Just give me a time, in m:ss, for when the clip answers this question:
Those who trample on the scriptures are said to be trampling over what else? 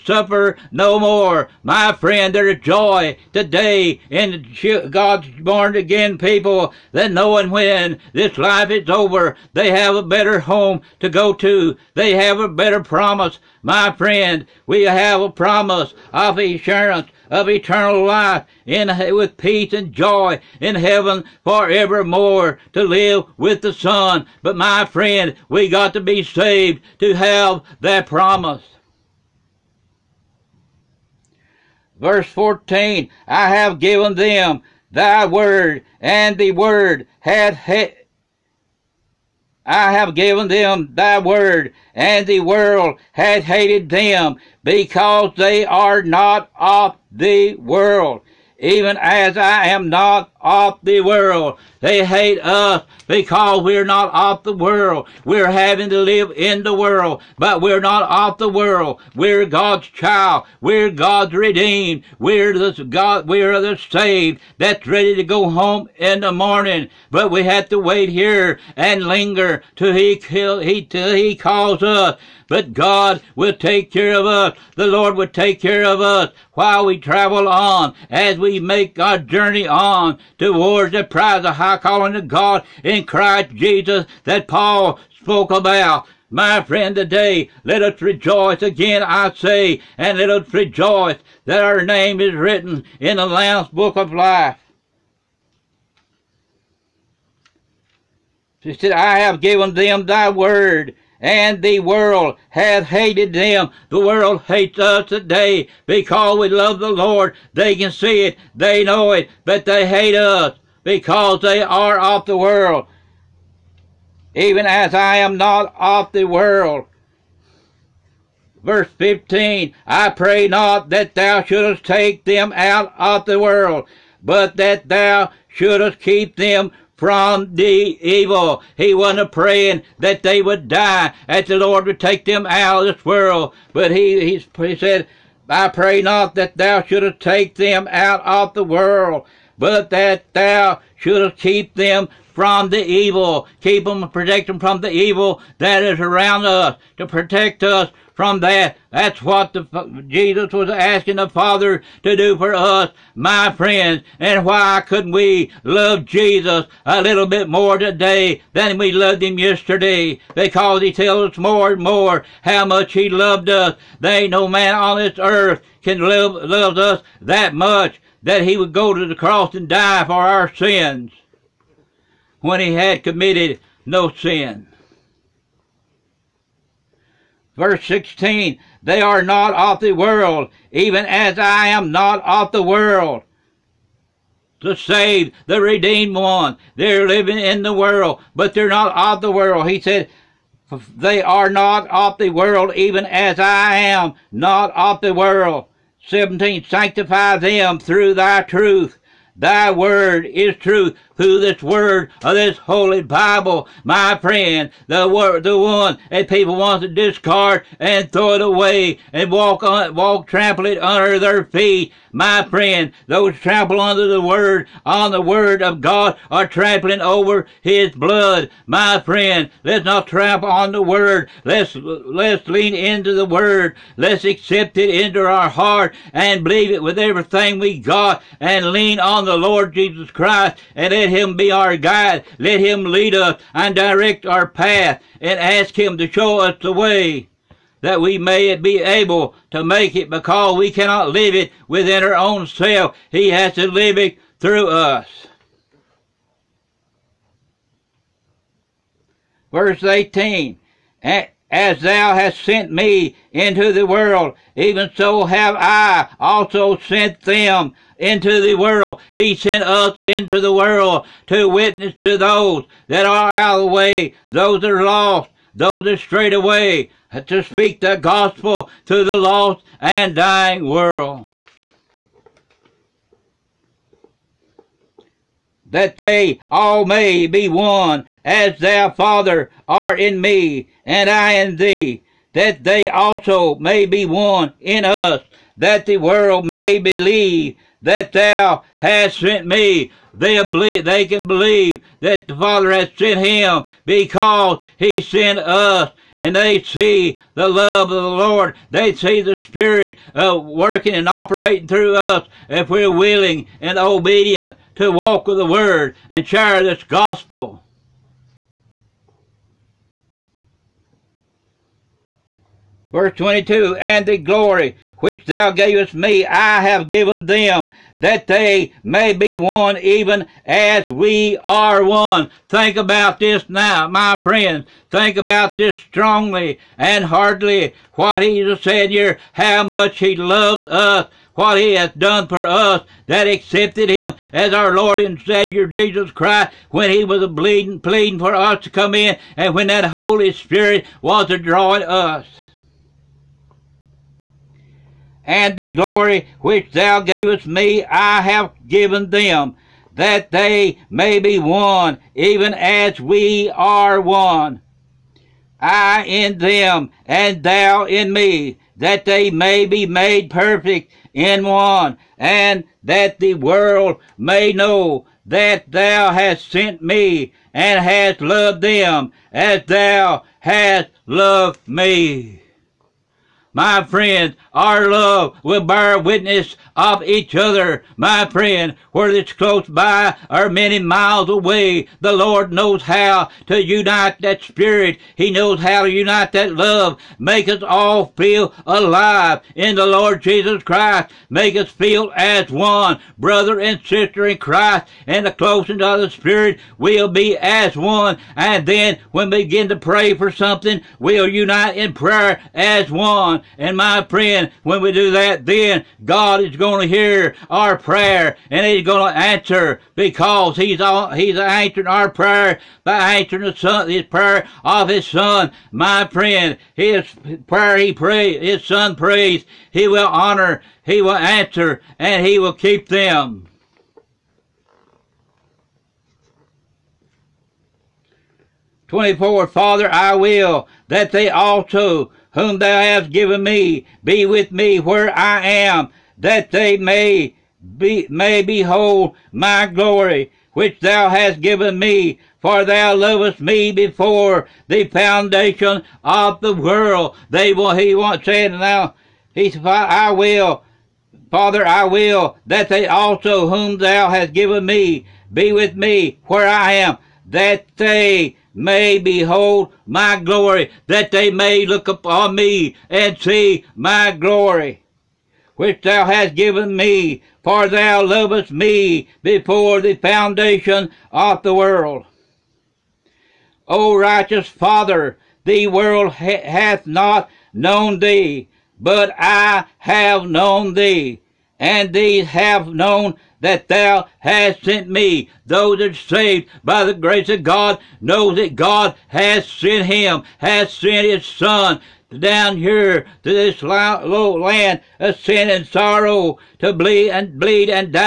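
3:37.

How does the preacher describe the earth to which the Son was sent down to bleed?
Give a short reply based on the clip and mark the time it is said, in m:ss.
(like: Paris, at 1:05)
low land of sin and sorrow, at 8:13.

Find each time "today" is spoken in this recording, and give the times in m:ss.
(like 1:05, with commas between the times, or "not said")
0:03, 1:26, 1:45, 2:37.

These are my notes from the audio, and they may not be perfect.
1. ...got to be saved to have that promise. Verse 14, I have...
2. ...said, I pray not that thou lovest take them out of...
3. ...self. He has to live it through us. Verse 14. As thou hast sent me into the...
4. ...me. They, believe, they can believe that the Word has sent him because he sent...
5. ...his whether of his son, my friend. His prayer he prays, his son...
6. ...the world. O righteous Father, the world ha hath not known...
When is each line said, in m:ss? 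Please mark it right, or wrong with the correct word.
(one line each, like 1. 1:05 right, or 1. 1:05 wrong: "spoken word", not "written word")
1. 0:25 right
2. 2:14 wrong: "shouldest", not "lovest"
3. 4:02 wrong: "18", not "14"
4. 4:49 wrong: "Father", not "Word"
5. 6:53 wrong: "prayer", not "whether"
6. 7:51 right.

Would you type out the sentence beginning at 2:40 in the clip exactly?
Because he tells us more and more how much he loved us.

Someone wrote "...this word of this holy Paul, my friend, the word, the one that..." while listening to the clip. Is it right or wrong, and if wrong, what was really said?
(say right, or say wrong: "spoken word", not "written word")
wrong: "Bible", not "Paul".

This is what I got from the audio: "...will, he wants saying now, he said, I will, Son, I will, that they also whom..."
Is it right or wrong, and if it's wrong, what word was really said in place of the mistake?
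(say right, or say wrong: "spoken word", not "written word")
wrong: "Father", not "Son".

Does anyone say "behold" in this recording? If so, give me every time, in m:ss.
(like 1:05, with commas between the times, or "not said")
7:18, 7:38.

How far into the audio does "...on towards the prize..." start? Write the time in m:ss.
1:19.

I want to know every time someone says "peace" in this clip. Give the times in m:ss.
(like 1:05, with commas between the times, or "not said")
0:19.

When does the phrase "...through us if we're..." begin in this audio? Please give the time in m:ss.
5:01.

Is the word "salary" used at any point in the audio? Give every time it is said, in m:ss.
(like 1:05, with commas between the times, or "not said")
not said.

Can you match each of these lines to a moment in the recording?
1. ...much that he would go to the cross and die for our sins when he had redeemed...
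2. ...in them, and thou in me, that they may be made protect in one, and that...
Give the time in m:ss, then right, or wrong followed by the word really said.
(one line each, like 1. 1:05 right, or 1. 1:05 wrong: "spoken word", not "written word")
1. 2:47 wrong: "committed", not "redeemed"
2. 5:56 wrong: "perfect", not "protect".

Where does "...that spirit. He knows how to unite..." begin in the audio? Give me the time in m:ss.
6:24.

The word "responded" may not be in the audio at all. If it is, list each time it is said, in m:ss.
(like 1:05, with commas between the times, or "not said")
not said.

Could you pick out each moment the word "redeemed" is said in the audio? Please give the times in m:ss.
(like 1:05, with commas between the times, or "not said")
1:01, 3:05.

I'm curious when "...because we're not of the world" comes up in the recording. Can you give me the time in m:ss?
0:53.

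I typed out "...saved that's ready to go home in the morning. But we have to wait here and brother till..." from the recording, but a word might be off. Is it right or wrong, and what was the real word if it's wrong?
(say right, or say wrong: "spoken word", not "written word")
wrong: "linger", not "brother".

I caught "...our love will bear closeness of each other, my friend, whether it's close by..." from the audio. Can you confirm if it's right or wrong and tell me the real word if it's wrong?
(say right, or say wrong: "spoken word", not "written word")
wrong: "witness", not "closeness".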